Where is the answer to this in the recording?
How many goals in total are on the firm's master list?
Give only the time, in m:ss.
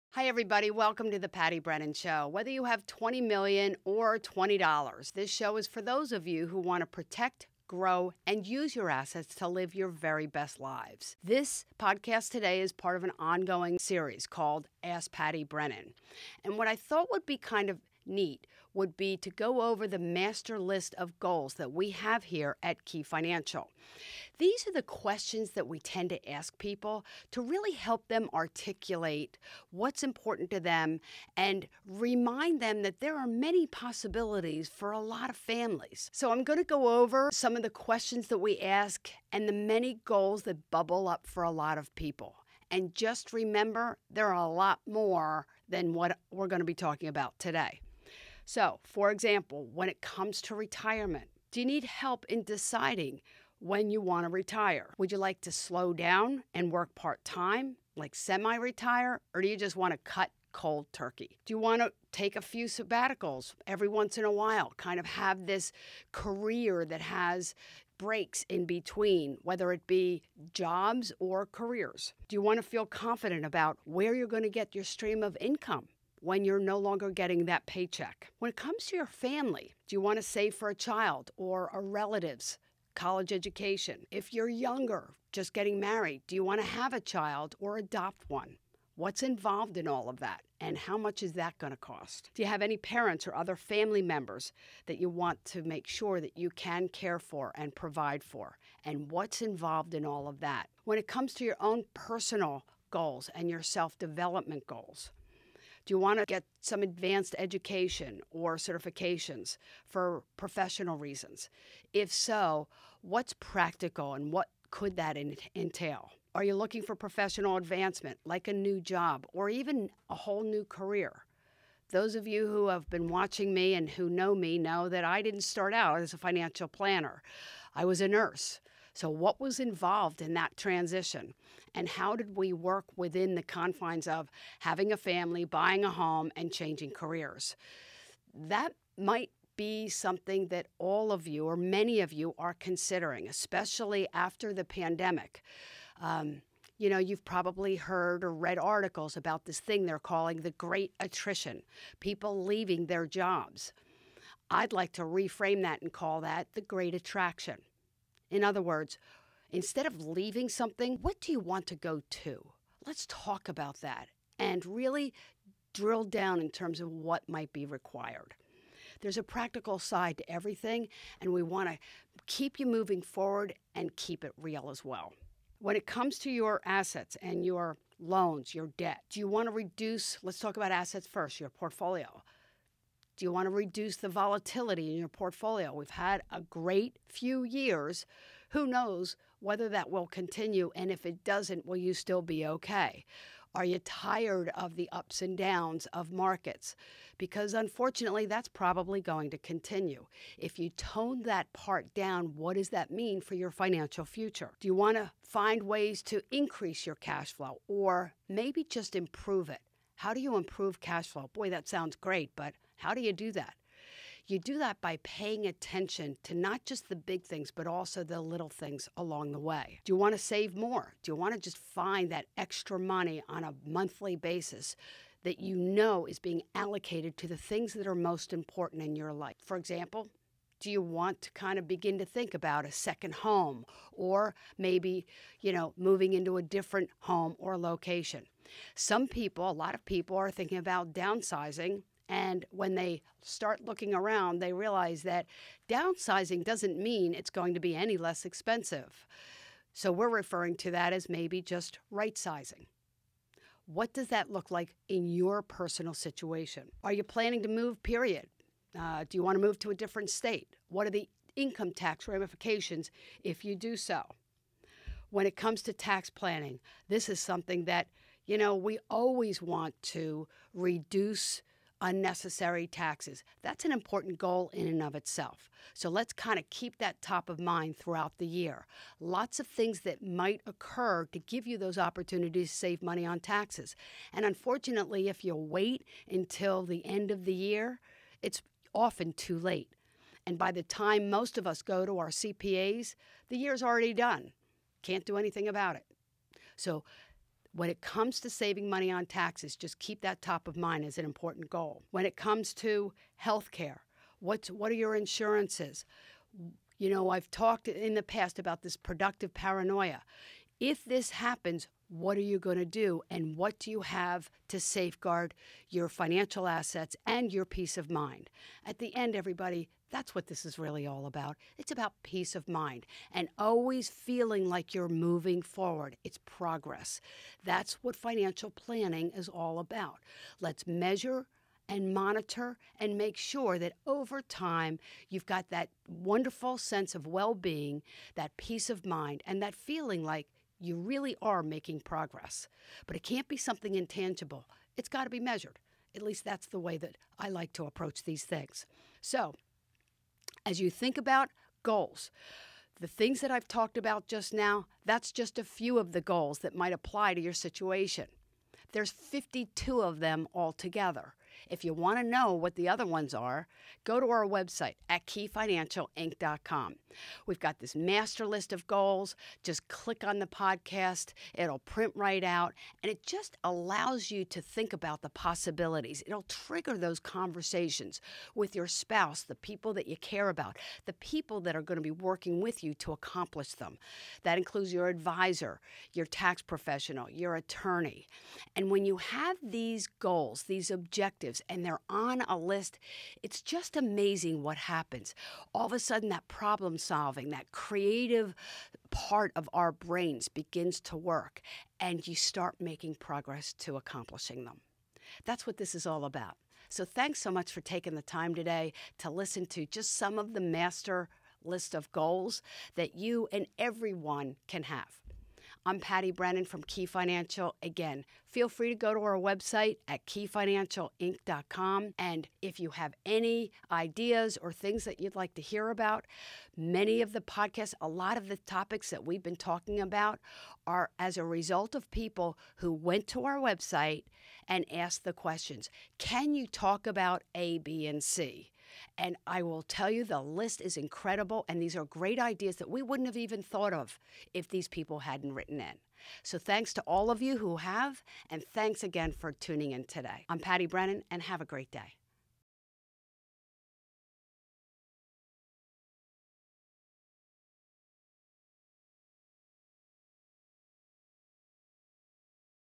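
5:58.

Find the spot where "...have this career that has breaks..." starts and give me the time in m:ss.
1:05.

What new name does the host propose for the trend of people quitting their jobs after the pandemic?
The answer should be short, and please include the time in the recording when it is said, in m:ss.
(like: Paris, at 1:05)
The great attraction, at 2:36.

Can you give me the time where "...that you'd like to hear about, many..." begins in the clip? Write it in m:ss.
7:04.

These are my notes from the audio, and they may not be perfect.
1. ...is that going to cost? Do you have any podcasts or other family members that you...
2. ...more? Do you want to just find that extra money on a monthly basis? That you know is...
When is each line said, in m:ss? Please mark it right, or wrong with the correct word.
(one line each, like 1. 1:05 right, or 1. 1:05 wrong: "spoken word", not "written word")
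1. 1:31 wrong: "parents", not "podcasts"
2. 3:40 right.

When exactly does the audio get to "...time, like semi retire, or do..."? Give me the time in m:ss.
0:57.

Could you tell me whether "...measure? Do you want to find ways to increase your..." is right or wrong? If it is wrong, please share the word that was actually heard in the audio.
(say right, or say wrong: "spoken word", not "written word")
wrong: "future", not "measure".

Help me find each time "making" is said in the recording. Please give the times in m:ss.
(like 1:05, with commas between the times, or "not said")
5:41, 6:42.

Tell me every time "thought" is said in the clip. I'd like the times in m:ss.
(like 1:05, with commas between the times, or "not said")
0:16, 7:23.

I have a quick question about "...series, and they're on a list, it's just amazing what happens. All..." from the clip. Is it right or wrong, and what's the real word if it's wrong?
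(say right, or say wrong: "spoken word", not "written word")
wrong: "objectives", not "series".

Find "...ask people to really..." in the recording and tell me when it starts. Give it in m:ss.
0:26.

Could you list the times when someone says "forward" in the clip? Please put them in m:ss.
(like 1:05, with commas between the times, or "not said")
2:53, 5:25.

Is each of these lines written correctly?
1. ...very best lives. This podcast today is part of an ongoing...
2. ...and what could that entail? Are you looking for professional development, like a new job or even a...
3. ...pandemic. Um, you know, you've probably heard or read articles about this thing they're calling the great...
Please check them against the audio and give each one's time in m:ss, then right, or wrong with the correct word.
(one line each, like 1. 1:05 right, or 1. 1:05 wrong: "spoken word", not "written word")
1. 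0:09 right
2. 1:54 wrong: "advancement", not "development"
3. 2:24 right.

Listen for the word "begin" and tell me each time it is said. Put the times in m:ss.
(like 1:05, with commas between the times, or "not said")
3:51, 6:40.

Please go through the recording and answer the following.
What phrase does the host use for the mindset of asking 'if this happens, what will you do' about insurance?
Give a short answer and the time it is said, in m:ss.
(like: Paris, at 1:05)
Productive paranoia, at 5:08.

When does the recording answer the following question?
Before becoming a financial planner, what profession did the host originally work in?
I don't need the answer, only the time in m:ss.
2:07.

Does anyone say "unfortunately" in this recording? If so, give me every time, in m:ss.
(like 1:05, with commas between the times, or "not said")
3:17, 4:44.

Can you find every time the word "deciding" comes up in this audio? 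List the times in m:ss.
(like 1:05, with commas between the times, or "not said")
0:52.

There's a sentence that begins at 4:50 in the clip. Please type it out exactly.
And by the time most of us go to our CPAs, the year's already done.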